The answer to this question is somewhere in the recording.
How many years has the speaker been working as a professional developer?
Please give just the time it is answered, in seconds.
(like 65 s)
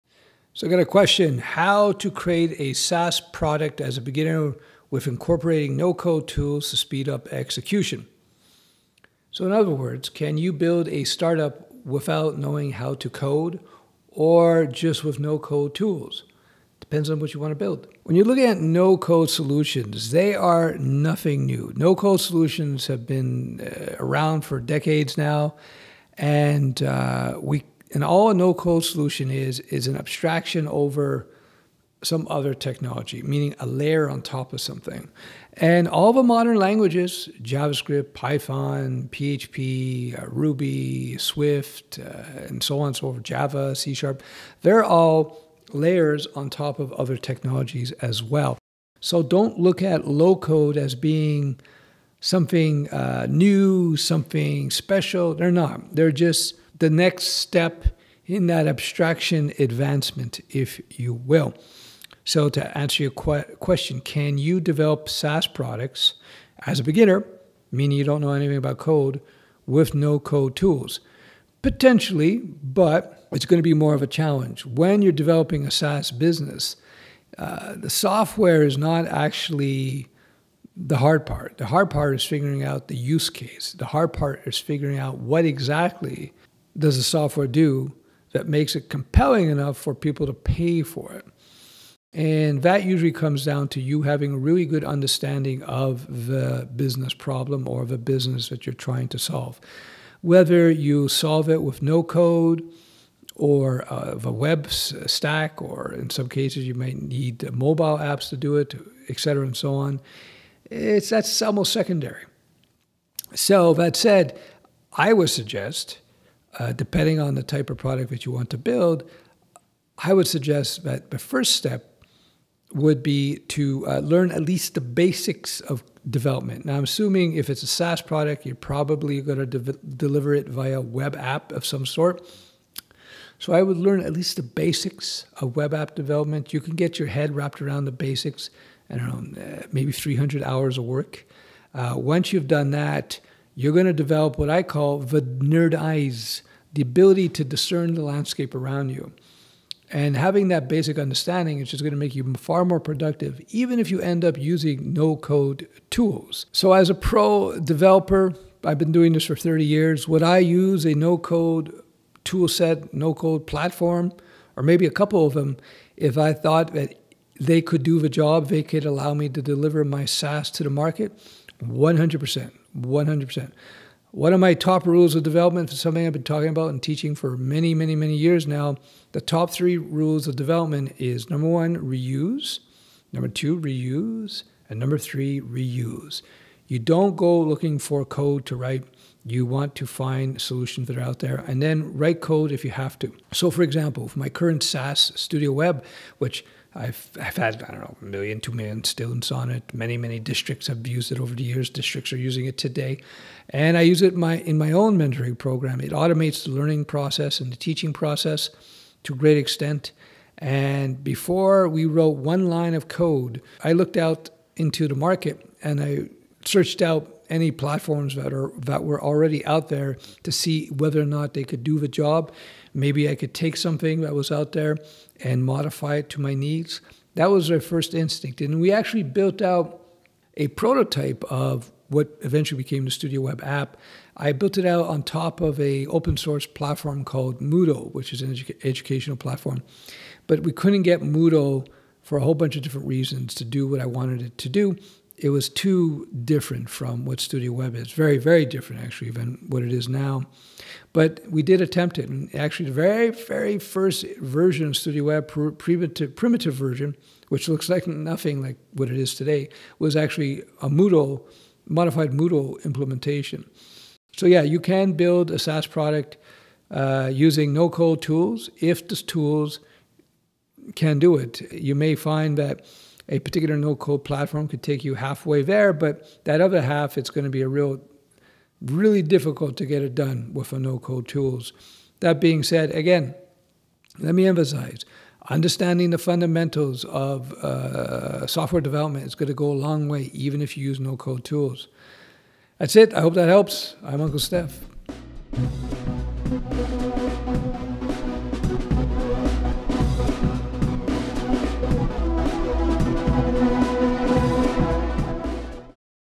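159 s.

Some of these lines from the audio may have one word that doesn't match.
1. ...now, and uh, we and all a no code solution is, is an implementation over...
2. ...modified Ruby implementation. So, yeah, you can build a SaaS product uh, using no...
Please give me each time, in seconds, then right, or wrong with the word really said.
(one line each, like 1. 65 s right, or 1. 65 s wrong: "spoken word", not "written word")
1. 25 s wrong: "abstraction", not "implementation"
2. 261 s wrong: "Moodle", not "Ruby".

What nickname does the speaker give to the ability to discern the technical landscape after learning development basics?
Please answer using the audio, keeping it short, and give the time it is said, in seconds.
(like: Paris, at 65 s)
nerd eyes, at 145 s.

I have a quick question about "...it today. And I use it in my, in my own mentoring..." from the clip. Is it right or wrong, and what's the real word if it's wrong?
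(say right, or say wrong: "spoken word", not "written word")
right.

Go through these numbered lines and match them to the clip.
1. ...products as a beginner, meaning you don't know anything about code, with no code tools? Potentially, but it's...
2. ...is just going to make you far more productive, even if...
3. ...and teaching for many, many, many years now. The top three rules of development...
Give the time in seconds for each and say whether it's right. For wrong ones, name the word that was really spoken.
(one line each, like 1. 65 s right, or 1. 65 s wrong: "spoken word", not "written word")
1. 65 s right
2. 151 s right
3. 176 s right.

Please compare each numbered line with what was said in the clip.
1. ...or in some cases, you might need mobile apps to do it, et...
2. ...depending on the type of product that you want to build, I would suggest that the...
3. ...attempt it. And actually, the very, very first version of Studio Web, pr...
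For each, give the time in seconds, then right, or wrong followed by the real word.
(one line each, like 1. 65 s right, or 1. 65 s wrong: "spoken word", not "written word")
1. 105 s right
2. 116 s right
3. 251 s right.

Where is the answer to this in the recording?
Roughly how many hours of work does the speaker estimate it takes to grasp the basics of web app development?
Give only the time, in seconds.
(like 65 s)
139 s.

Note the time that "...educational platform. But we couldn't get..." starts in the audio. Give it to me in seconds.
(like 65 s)
238 s.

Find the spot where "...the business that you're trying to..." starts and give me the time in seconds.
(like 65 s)
97 s.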